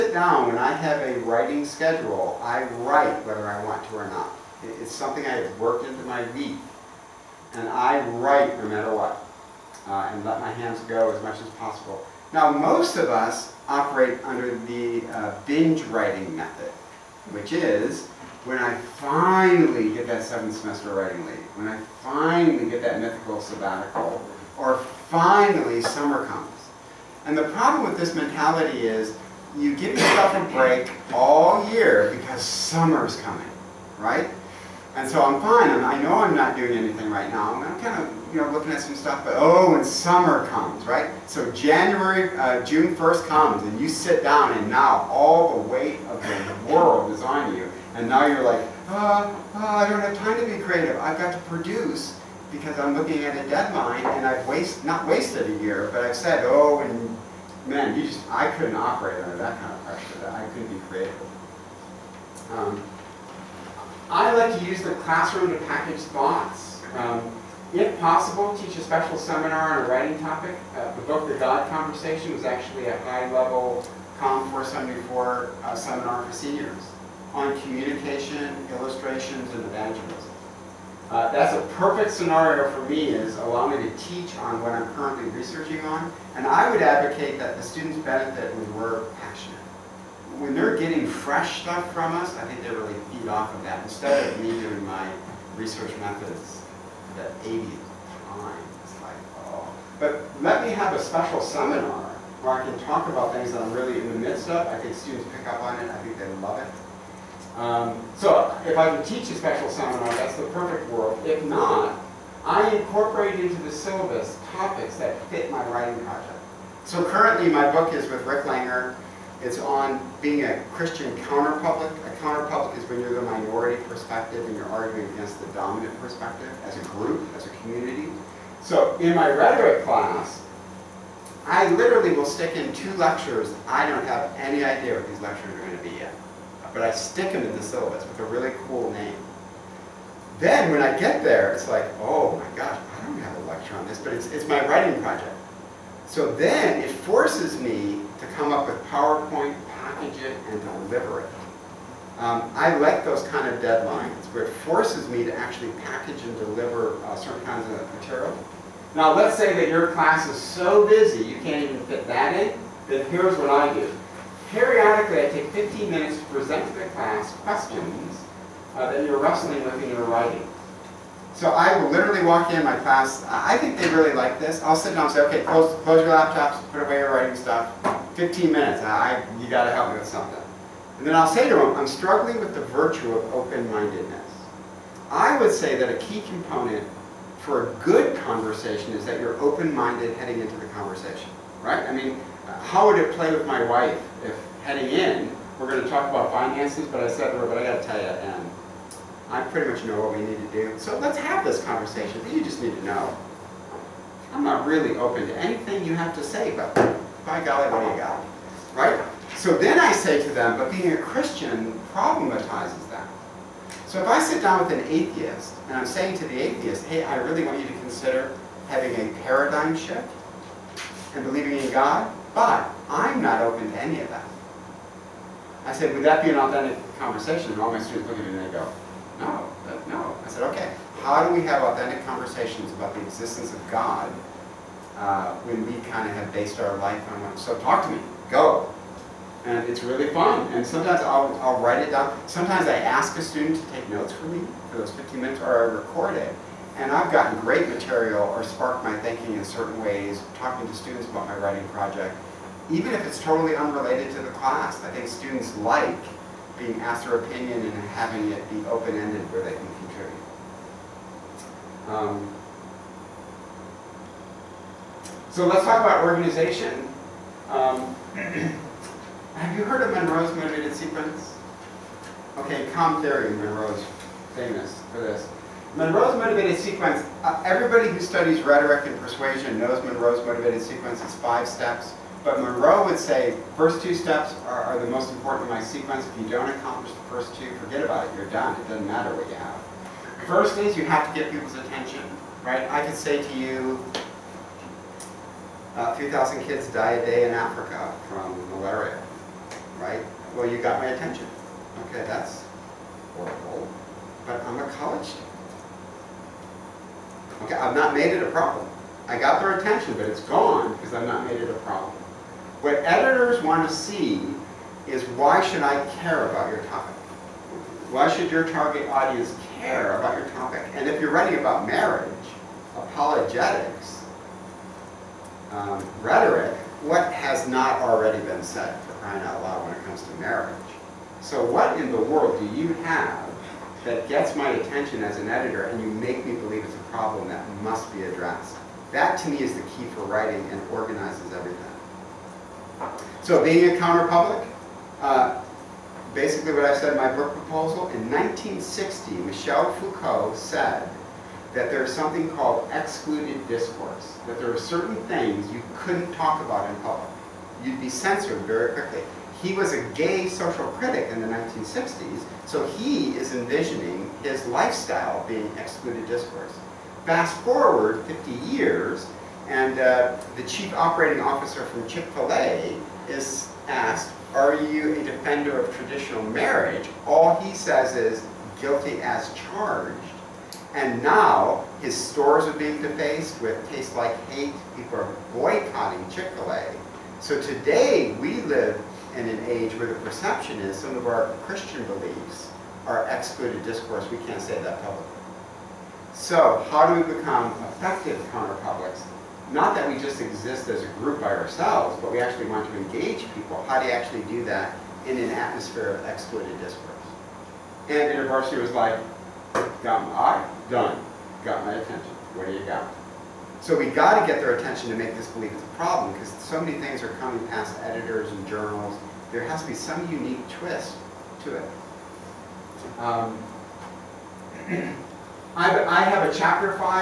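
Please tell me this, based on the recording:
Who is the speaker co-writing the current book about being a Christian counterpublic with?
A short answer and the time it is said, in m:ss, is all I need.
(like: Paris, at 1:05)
Rick Langer, at 1:58.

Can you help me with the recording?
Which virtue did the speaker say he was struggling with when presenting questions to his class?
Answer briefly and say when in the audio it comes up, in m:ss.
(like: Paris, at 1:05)
Open-mindedness, at 3:03.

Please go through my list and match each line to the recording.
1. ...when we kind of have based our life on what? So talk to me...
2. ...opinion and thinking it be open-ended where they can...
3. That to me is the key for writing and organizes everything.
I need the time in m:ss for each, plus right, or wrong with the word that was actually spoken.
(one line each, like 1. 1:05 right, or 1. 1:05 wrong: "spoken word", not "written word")
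1. 3:55 right
2. 4:17 wrong: "having", not "thinking"
3. 5:38 right.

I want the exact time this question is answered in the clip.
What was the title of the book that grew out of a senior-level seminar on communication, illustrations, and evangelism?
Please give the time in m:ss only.
1:11.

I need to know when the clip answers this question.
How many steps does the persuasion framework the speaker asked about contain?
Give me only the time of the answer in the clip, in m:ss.
4:41.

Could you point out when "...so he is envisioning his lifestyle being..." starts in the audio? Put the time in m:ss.
6:02.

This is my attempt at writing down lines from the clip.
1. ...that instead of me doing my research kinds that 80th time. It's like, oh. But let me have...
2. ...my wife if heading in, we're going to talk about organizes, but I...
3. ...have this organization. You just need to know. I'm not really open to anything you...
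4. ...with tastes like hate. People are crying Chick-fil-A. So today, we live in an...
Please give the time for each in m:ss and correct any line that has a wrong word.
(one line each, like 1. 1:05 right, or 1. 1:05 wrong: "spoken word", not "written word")
1. 1:33 wrong: "methods", not "kinds"
2. 3:13 wrong: "finances", not "organizes"
3. 3:21 wrong: "conversation", not "organization"
4. 6:23 wrong: "boycotting", not "crying".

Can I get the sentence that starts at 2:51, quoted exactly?
So I will literally walk in my class.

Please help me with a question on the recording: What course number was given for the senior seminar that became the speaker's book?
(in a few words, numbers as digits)
COM 474.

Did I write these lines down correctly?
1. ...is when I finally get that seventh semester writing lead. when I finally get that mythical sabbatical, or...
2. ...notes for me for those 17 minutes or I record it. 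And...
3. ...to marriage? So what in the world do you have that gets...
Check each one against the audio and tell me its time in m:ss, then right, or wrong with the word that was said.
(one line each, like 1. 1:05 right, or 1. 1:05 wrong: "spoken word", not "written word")
1. 0:17 right
2. 4:03 wrong: "15", not "17"
3. 5:30 right.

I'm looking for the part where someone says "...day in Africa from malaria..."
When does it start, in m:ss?
4:57.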